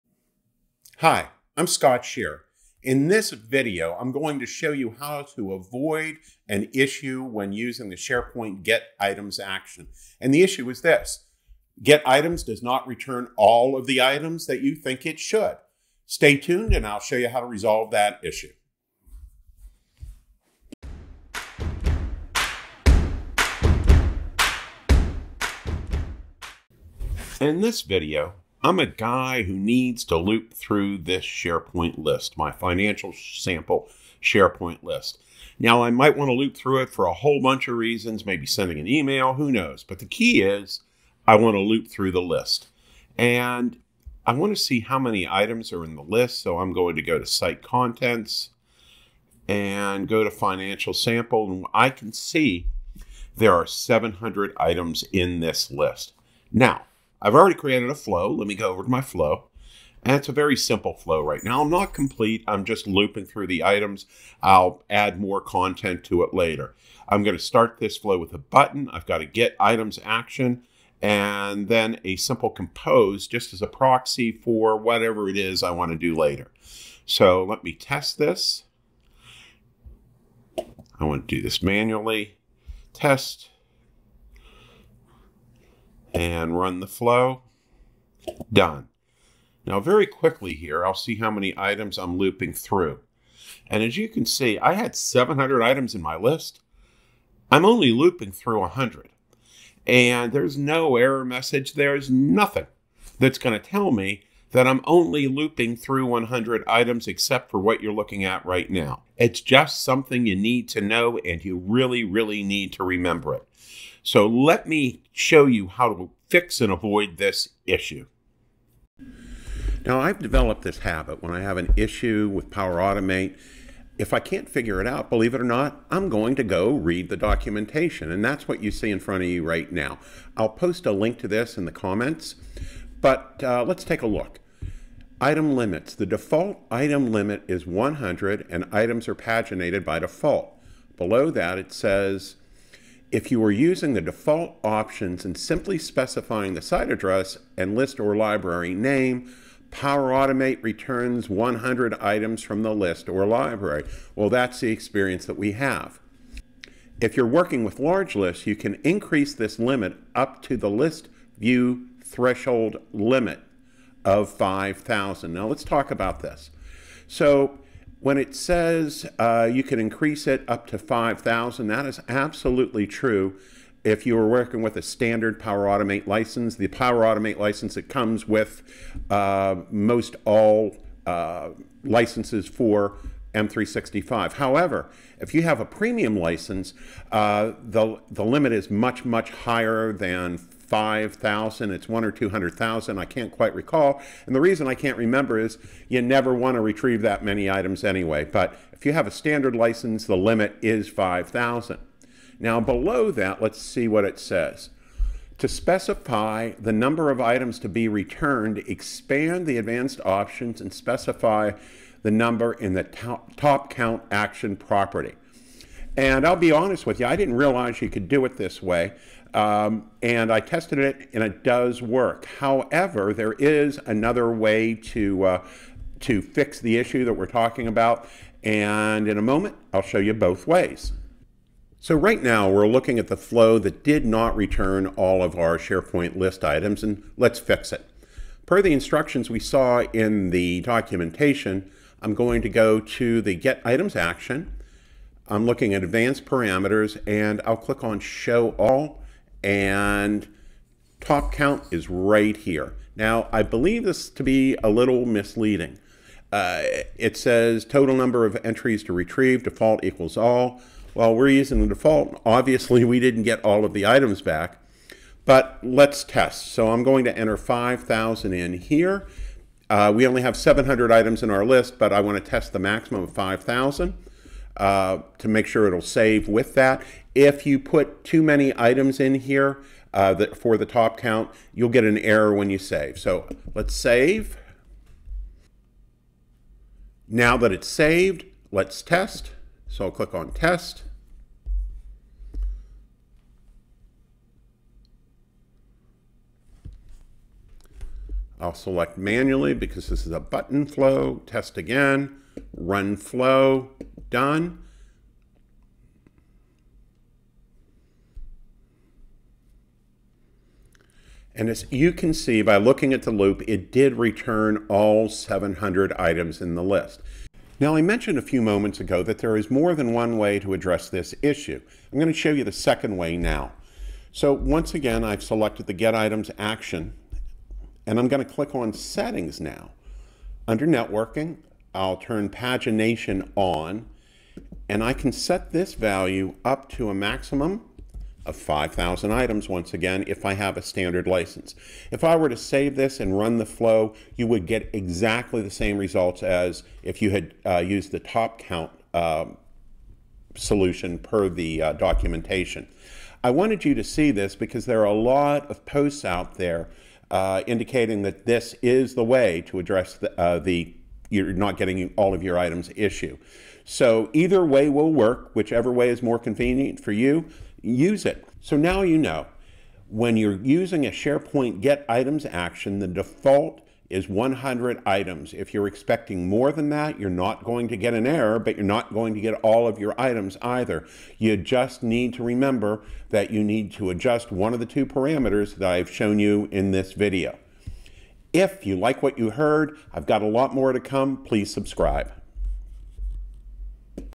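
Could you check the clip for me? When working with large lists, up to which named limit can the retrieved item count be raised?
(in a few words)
list view threshold.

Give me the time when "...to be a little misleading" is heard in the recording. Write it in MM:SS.
04:14.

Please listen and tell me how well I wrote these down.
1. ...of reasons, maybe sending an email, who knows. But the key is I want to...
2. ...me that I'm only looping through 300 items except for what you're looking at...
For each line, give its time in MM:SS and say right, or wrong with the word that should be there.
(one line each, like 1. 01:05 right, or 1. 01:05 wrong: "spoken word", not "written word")
1. 00:37 right
2. 01:43 wrong: "100", not "300".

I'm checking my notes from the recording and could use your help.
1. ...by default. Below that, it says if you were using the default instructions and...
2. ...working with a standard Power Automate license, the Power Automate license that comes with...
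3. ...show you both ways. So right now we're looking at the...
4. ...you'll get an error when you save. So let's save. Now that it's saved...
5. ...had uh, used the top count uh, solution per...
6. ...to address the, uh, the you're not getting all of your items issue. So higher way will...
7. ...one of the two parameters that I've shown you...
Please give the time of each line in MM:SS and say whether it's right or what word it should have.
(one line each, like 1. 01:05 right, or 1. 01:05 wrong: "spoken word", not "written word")
1. 02:19 wrong: "options", not "instructions"
2. 02:54 right
3. 03:49 right
4. 04:41 right
5. 05:47 right
6. 05:59 wrong: "either", not "higher"
7. 06:24 right.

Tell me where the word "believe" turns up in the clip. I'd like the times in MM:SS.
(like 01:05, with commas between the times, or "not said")
02:05, 04:13.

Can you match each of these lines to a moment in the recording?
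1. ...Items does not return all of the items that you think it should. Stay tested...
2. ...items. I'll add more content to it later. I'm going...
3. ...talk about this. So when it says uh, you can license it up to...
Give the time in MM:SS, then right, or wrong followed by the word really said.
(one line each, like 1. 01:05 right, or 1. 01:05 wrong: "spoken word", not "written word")
1. 00:12 wrong: "tuned", not "tested"
2. 01:03 right
3. 02:45 wrong: "increase", not "license".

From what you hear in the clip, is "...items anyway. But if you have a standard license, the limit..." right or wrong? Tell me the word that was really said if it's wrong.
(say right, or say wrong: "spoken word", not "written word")
right.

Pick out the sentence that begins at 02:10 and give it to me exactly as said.
I'll post a link to this in the comments, but uh, let's take a look.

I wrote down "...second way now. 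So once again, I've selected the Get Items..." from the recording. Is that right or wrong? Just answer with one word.
right.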